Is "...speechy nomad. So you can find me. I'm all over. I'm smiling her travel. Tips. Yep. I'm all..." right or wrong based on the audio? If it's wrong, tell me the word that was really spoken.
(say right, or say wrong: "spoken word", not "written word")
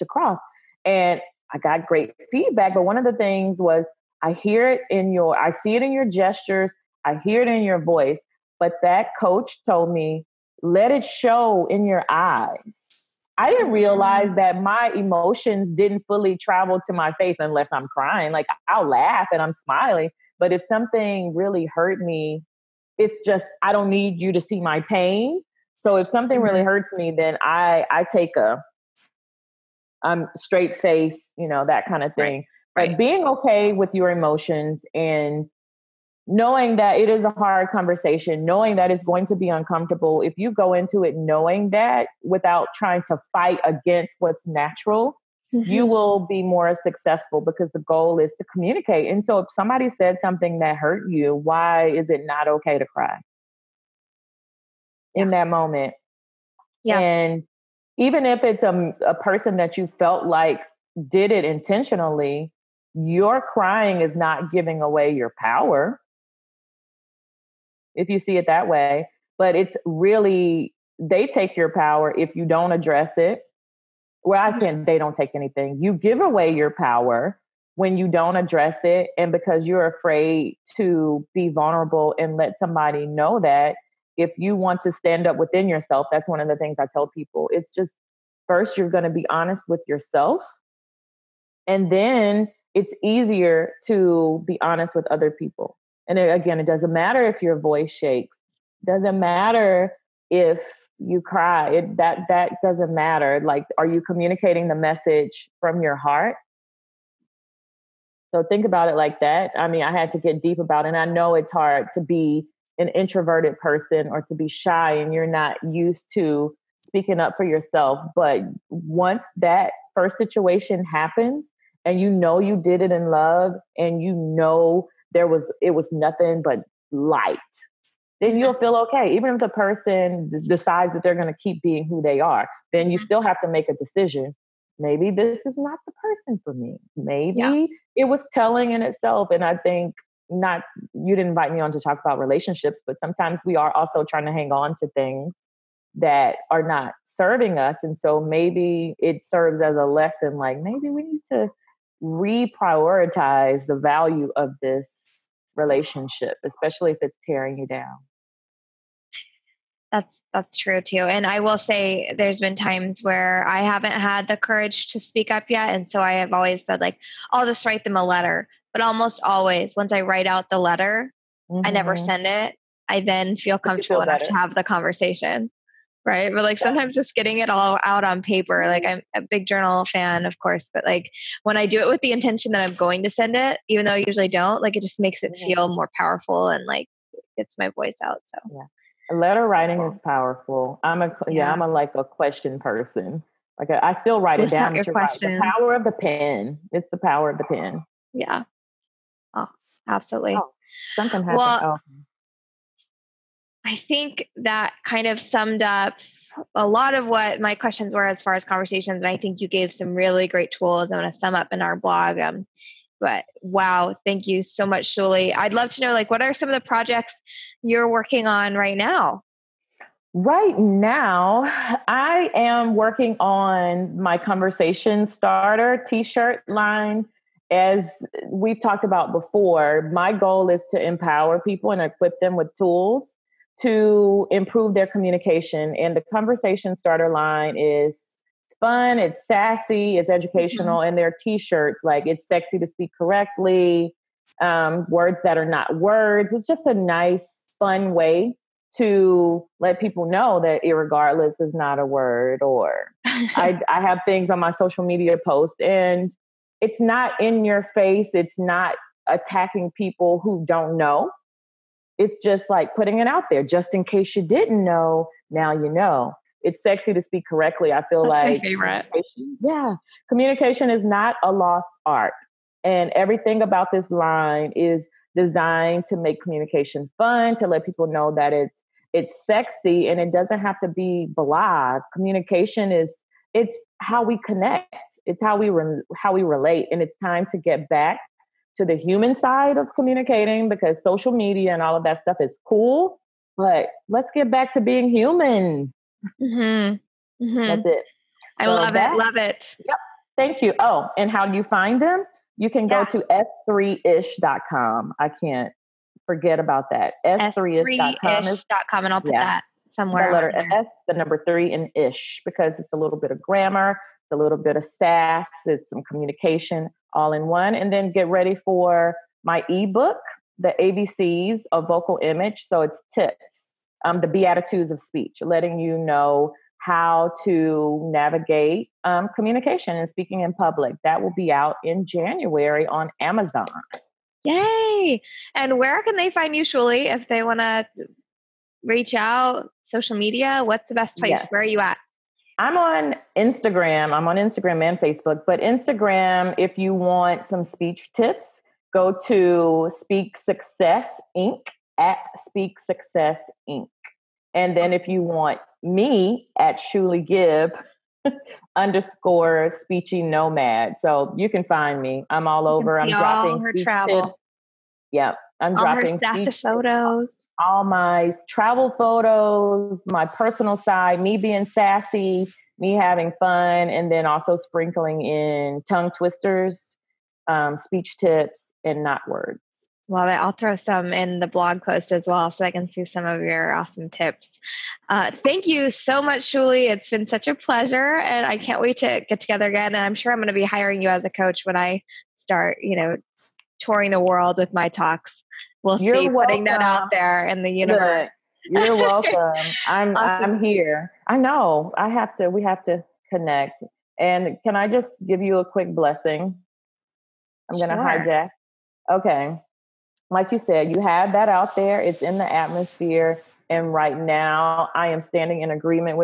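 wrong: "dropping", not "smiling".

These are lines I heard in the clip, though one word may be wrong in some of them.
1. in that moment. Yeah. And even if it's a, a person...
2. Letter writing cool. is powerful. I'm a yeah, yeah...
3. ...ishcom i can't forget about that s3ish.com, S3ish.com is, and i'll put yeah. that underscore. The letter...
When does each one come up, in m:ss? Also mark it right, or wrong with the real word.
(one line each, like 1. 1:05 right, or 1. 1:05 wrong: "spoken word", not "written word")
1. 0:55 right
2. 3:09 right
3. 5:03 wrong: "somewhere", not "underscore".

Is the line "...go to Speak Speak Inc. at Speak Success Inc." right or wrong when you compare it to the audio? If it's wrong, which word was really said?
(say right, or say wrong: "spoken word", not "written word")
wrong: "Success", not "Speak".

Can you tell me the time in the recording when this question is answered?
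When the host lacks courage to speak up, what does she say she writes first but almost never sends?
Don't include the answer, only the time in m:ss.
2:47.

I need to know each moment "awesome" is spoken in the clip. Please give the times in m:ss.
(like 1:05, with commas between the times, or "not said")
6:23, 6:39.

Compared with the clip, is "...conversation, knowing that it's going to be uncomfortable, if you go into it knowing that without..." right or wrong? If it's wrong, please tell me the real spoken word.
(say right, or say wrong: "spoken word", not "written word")
right.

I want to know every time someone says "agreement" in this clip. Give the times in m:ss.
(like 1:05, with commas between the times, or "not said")
6:55.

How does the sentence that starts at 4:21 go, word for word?
It's just like putting it out there just in case you didn't know, now you know.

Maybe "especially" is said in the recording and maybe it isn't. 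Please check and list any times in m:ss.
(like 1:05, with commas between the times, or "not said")
2:36.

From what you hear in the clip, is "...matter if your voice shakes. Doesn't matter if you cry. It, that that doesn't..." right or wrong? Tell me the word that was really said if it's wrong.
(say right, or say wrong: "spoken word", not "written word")
right.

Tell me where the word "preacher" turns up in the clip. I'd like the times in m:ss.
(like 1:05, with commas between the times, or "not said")
not said.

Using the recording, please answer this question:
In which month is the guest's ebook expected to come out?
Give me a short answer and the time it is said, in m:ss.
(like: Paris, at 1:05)
January, at 5:31.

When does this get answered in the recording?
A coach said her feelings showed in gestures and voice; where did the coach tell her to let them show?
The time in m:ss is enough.
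0:10.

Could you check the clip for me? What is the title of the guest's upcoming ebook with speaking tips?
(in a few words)
The ABCs of vocal image.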